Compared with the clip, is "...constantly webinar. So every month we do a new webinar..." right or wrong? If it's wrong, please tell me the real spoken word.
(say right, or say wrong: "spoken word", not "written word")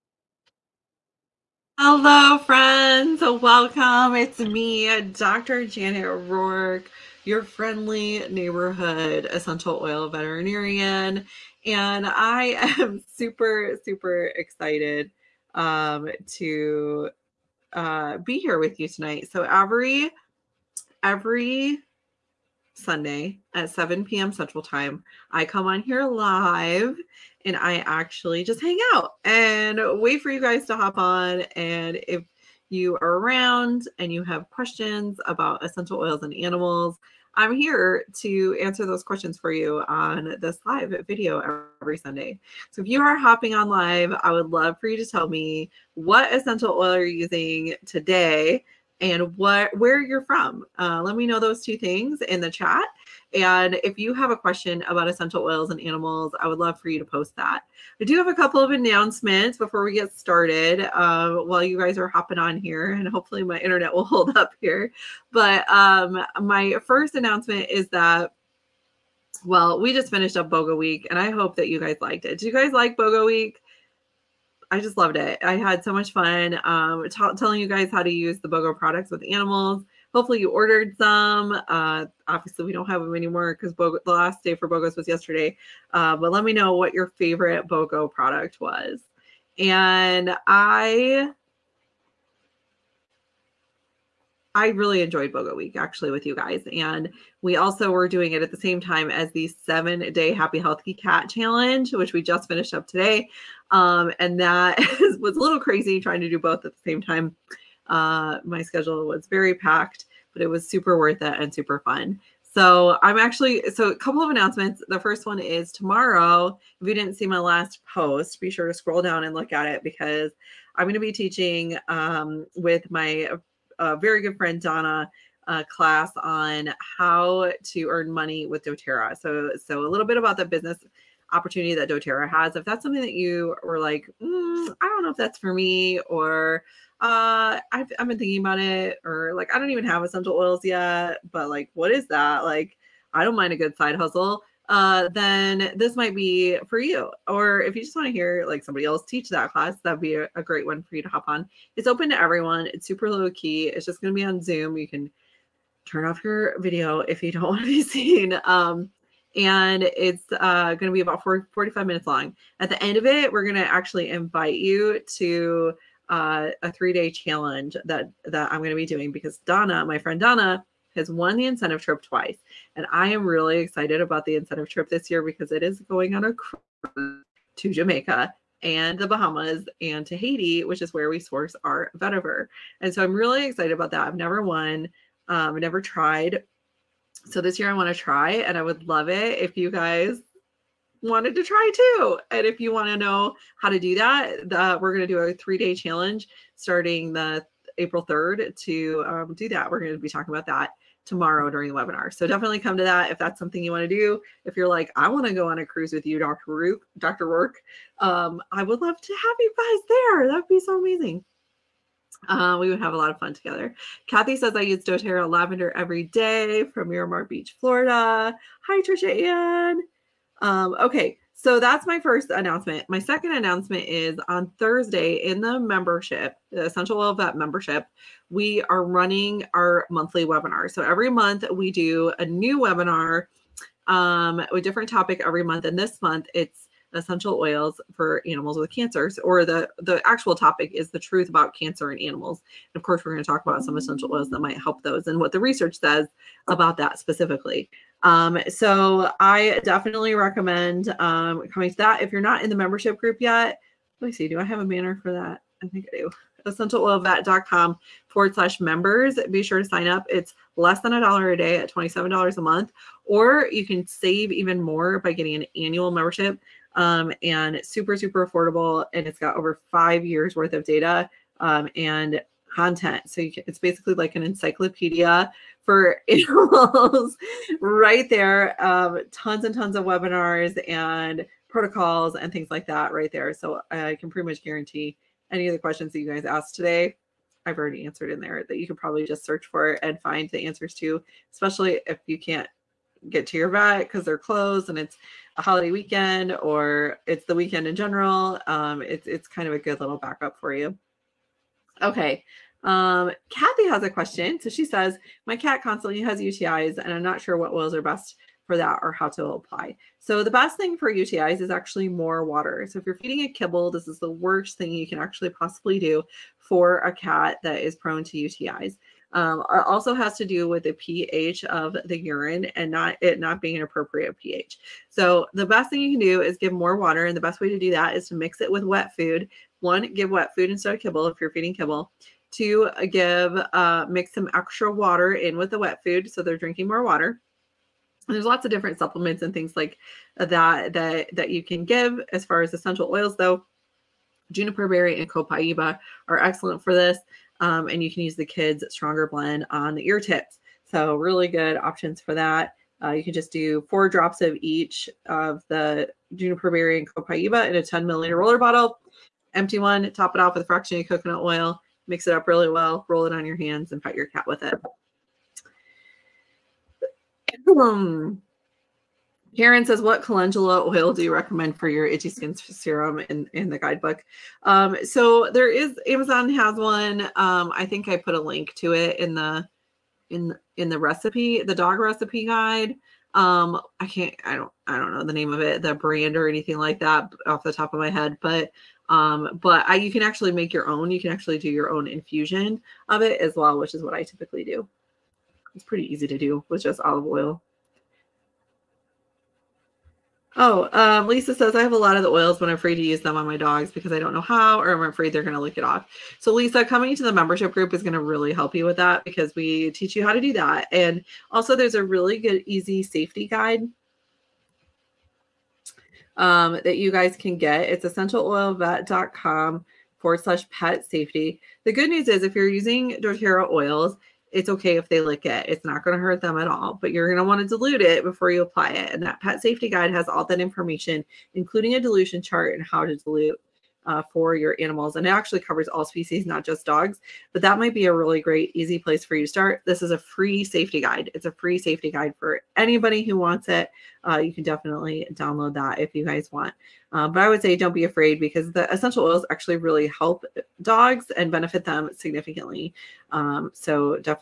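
wrong: "monthly", not "constantly".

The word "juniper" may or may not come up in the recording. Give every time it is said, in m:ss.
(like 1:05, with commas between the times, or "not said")
5:44, 5:56.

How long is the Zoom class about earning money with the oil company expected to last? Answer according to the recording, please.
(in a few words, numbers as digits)
45 minutes.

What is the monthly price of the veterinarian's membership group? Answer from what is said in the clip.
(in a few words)
$27.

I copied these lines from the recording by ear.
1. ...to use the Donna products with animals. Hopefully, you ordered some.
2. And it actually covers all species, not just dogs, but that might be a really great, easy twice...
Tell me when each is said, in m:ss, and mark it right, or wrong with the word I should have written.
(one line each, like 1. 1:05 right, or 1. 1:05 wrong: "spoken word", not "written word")
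1. 1:18 wrong: "BOGO", not "Donna"
2. 7:14 wrong: "place", not "twice".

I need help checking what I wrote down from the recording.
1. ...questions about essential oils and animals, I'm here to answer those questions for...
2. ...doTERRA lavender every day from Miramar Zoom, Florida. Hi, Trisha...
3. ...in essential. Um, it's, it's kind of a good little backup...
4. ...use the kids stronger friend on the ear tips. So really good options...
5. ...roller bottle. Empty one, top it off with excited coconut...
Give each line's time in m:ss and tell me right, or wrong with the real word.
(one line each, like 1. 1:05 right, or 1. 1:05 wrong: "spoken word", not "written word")
1. 0:34 right
2. 3:34 wrong: "Beach", not "Zoom"
3. 4:57 wrong: "general", not "essential"
4. 5:48 wrong: "blend", not "friend"
5. 5:58 wrong: "fractionated", not "excited".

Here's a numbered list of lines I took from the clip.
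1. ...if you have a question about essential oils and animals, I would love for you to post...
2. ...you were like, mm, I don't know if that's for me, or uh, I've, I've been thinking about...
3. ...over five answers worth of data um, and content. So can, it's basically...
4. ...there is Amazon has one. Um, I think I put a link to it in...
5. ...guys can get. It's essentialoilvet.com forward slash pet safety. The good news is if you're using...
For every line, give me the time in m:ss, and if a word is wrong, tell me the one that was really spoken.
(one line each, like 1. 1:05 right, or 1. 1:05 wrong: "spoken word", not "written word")
1. 0:53 right
2. 2:13 right
3. 4:29 wrong: "years", not "answers"
4. 6:15 right
5. 6:56 right.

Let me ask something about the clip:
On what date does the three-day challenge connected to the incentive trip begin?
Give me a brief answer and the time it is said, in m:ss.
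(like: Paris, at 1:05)
April 3rd, at 3:17.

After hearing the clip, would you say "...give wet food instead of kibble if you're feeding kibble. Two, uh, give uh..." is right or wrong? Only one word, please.
right.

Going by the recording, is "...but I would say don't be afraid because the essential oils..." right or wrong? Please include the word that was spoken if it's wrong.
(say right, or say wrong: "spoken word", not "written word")
right.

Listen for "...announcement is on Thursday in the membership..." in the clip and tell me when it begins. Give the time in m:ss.
3:43.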